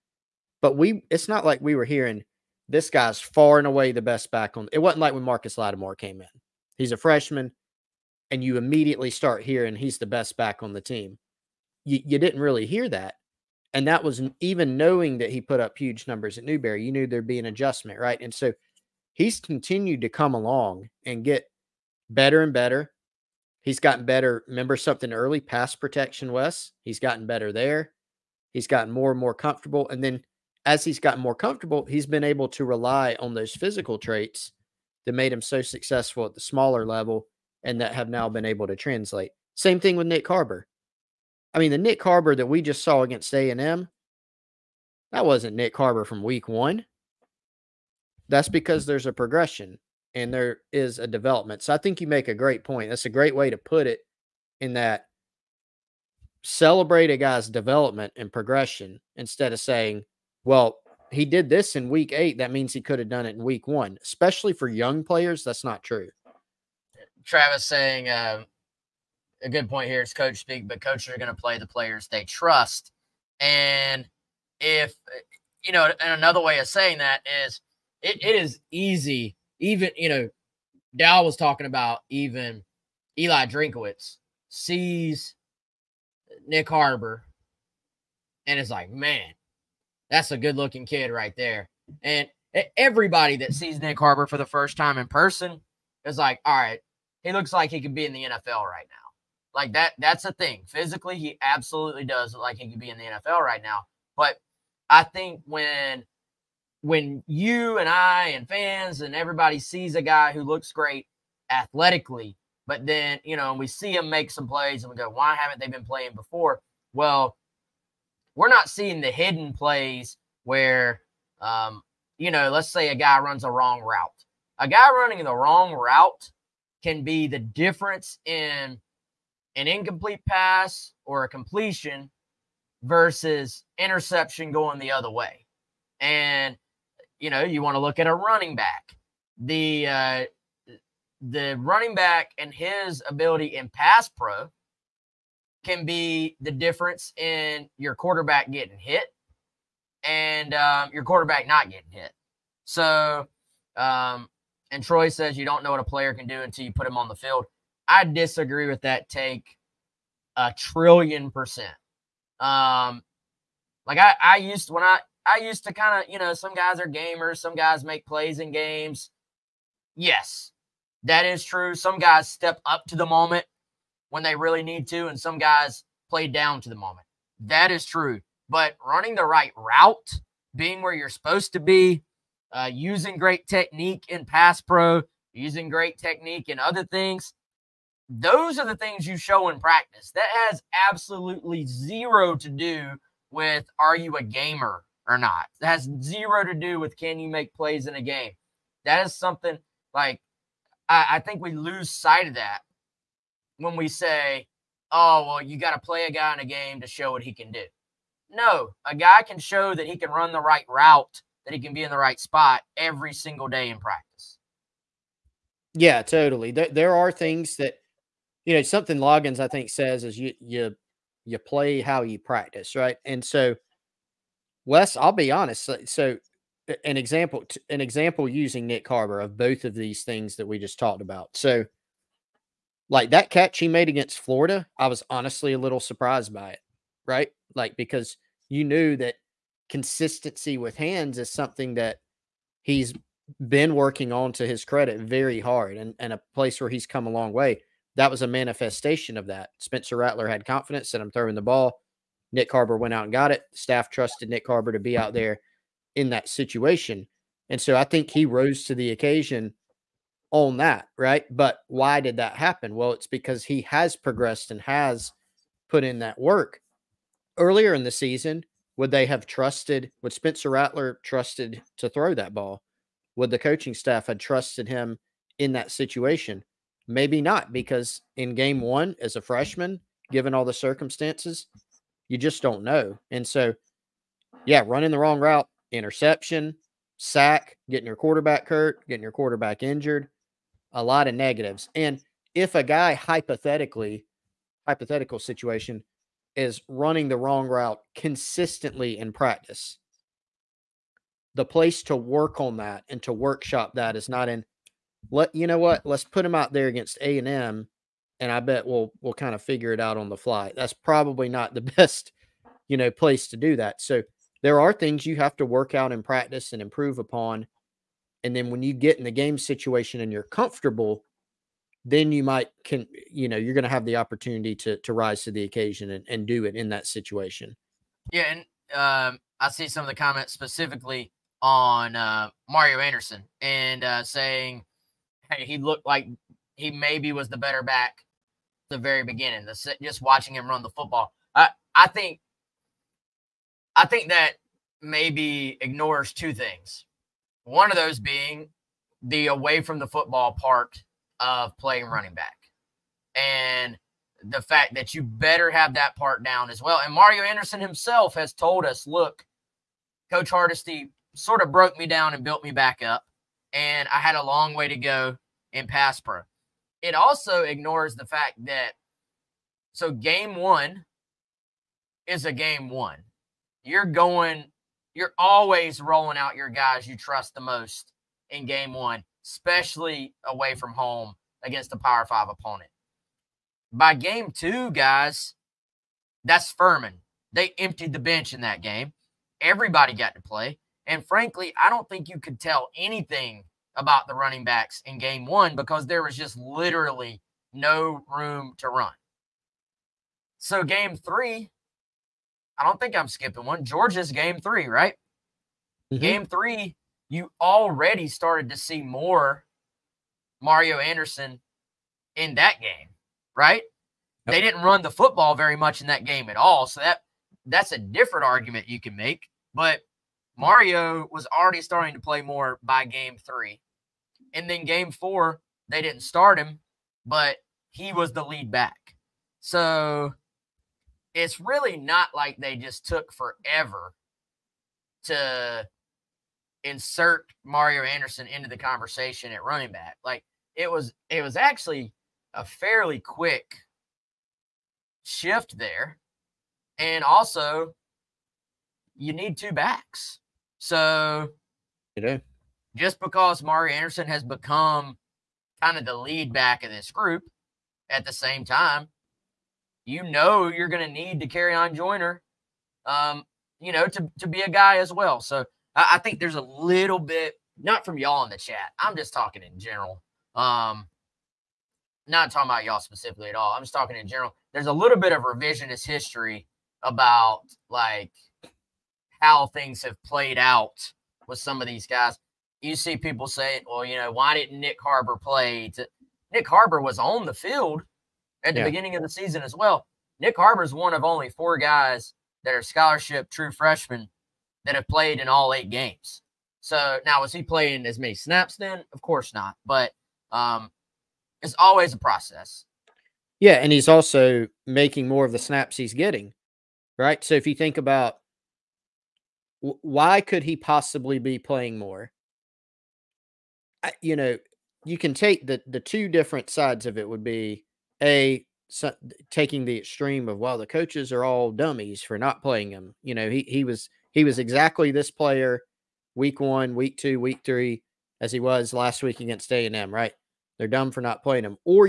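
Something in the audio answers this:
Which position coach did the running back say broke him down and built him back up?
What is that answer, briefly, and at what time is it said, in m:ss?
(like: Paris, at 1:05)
Coach Hardesty, at 6:00.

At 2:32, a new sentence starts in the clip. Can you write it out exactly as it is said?
So, um, and Troy says you don't know what a player can do until you put him on the field.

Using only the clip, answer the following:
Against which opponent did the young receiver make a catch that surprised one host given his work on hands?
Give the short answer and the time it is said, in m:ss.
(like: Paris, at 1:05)
Florida, at 3:54.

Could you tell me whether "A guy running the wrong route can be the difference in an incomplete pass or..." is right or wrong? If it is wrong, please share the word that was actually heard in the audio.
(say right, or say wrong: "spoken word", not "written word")
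right.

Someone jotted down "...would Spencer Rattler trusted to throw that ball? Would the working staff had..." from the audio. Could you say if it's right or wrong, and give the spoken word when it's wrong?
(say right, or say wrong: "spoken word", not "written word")
wrong: "coaching", not "working".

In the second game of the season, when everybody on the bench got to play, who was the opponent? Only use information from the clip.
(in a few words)
Furman.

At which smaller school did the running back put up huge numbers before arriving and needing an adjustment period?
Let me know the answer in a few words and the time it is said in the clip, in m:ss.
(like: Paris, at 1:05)
Newberry, at 0:16.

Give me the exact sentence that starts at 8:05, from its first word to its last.
To, Nick Harbor was on the field at the yeah.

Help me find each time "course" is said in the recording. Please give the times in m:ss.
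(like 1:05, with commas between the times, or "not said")
8:19.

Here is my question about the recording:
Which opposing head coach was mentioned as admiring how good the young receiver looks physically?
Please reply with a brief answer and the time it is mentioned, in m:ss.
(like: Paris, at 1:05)
Eli Drinkwitz, at 1:23.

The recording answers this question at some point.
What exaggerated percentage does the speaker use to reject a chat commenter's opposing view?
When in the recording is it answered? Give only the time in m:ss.
2:40.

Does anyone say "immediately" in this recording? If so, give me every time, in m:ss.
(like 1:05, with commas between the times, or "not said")
0:08.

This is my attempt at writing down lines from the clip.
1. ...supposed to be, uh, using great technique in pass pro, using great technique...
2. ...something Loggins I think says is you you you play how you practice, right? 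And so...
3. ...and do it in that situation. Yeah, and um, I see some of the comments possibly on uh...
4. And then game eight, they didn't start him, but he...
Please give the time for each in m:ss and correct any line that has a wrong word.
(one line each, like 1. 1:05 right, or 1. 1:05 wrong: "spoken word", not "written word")
1. 3:01 right
2. 3:38 right
3. 5:26 wrong: "specifically", not "possibly"
4. 7:04 wrong: "four", not "eight".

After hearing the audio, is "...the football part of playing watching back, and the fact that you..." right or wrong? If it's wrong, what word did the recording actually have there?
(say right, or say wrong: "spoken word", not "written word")
wrong: "running", not "watching".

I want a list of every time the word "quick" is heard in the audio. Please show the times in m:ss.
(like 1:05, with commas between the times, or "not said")
7:22.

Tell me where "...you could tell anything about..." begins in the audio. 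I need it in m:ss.
6:32.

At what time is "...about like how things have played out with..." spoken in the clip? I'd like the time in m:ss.
7:56.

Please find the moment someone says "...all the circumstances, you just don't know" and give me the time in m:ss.
4:40.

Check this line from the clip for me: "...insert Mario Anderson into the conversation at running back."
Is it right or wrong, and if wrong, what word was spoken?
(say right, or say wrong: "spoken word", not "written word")
right.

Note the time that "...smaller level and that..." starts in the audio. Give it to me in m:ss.
0:36.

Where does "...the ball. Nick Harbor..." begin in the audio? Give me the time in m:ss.
4:11.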